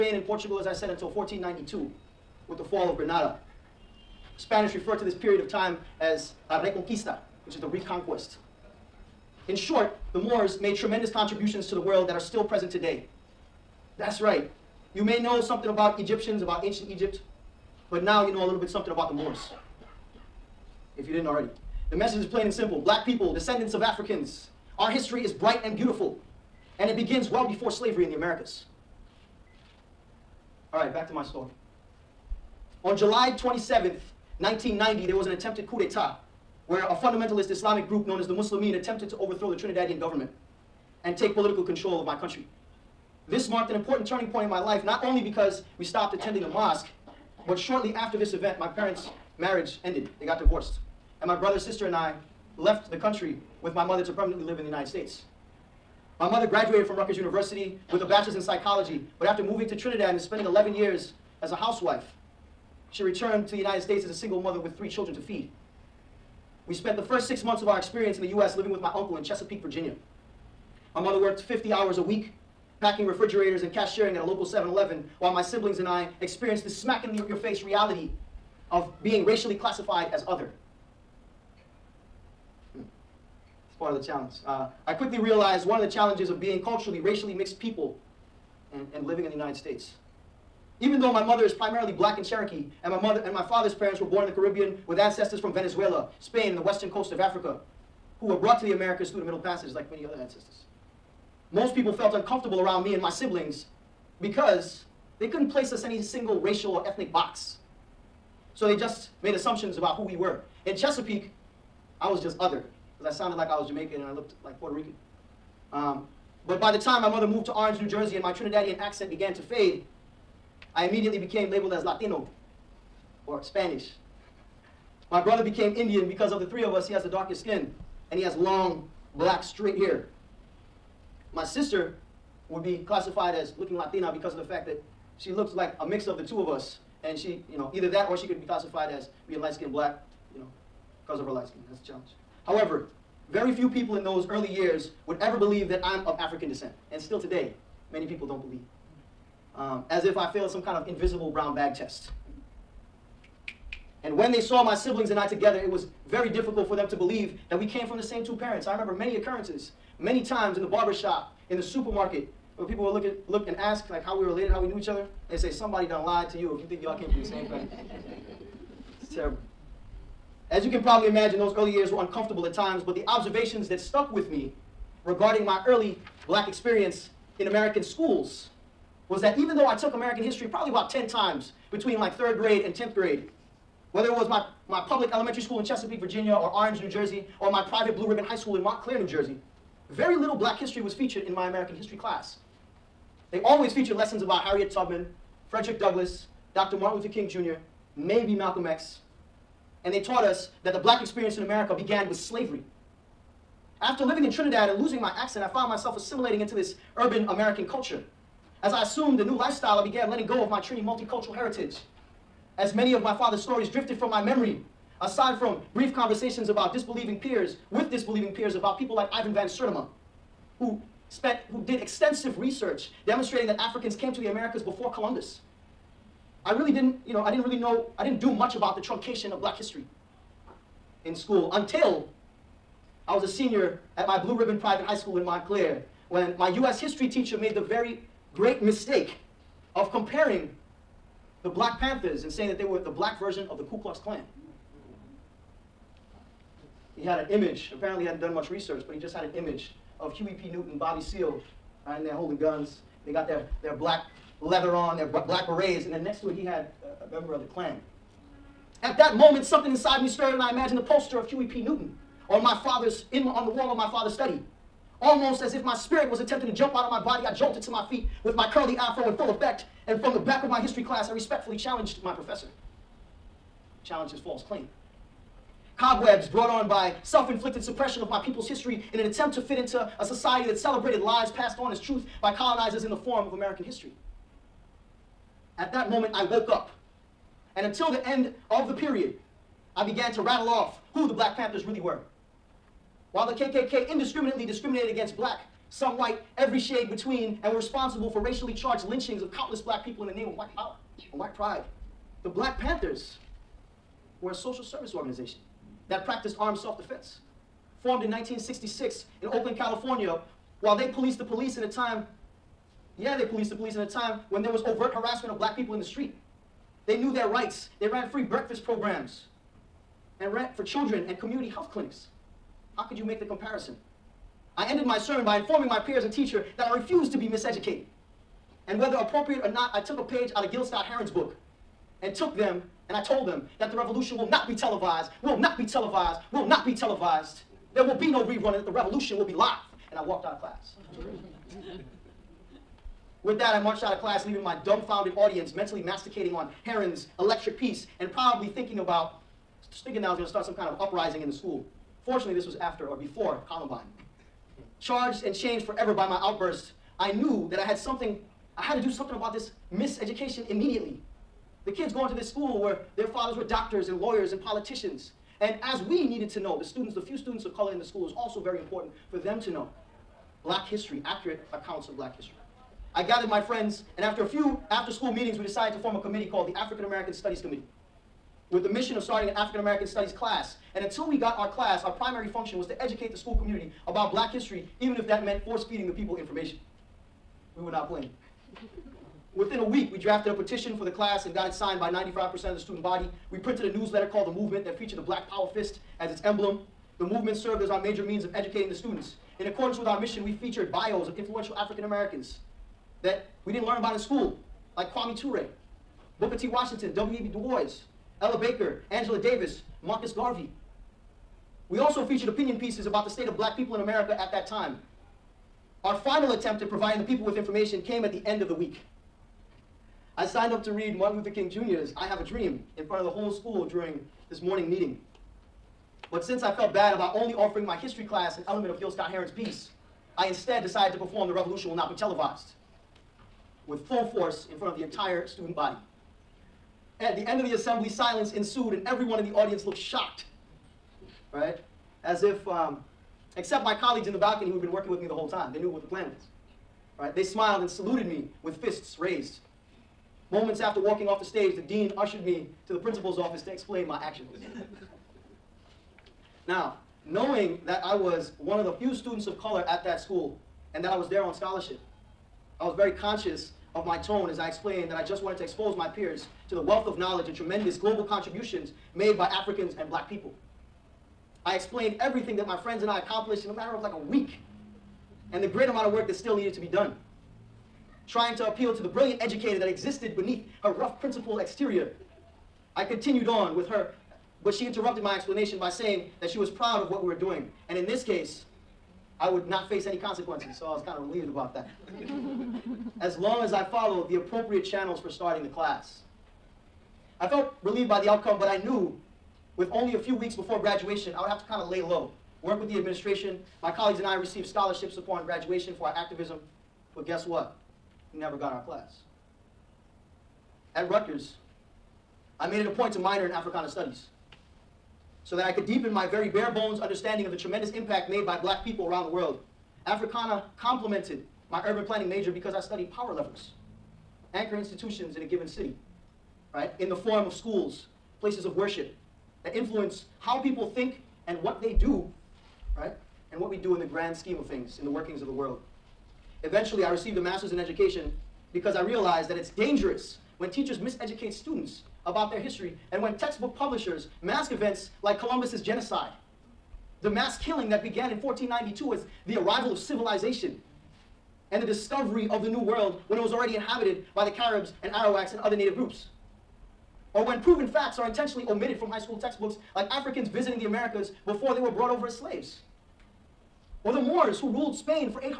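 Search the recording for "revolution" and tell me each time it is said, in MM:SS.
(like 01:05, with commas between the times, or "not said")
05:33, 05:38, 07:11.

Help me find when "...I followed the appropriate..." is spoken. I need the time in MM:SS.
08:13.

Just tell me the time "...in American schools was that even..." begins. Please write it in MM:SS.
02:57.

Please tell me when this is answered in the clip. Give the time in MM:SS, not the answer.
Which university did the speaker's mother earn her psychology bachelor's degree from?
00:56.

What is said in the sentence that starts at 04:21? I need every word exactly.
Newton on my father's in on the wall of my father's study.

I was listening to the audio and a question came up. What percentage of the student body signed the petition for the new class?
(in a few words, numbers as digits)
95%.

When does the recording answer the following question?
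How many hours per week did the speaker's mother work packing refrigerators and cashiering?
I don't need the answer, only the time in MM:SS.
01:11.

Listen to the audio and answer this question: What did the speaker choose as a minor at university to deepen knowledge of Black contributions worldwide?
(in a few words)
Africana Studies.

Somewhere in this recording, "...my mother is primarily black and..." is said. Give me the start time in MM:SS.
01:31.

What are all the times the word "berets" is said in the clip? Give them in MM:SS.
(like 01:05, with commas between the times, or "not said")
04:15.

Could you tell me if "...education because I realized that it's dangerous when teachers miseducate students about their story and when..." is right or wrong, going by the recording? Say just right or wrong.
wrong.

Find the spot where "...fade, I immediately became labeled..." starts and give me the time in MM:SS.
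01:59.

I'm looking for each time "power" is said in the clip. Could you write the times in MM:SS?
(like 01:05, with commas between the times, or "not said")
05:00, 06:35, 08:42.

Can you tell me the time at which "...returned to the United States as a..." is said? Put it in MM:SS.
01:03.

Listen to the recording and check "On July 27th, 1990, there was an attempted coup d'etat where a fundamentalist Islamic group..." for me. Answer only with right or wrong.
right.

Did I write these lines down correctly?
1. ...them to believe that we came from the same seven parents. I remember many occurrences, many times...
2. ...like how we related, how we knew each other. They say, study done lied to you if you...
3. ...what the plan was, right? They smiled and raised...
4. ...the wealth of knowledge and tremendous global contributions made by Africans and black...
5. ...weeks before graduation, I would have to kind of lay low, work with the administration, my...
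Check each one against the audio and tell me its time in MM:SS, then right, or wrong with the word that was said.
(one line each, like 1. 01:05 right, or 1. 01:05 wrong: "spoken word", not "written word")
1. 02:36 wrong: "two", not "seven"
2. 02:43 wrong: "somebody", not "study"
3. 07:25 wrong: "saluted", not "raised"
4. 07:46 right
5. 08:20 right.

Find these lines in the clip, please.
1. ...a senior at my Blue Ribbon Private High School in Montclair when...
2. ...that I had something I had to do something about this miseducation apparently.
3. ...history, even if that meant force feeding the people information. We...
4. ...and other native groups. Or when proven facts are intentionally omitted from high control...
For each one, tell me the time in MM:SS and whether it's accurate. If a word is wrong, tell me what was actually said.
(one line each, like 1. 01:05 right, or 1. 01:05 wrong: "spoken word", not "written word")
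1. 03:53 right
2. 05:57 wrong: "immediately", not "apparently"
3. 06:24 right
4. 09:15 wrong: "school", not "control".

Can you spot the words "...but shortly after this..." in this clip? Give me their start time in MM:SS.
00:47.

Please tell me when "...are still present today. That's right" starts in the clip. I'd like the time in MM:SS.
00:12.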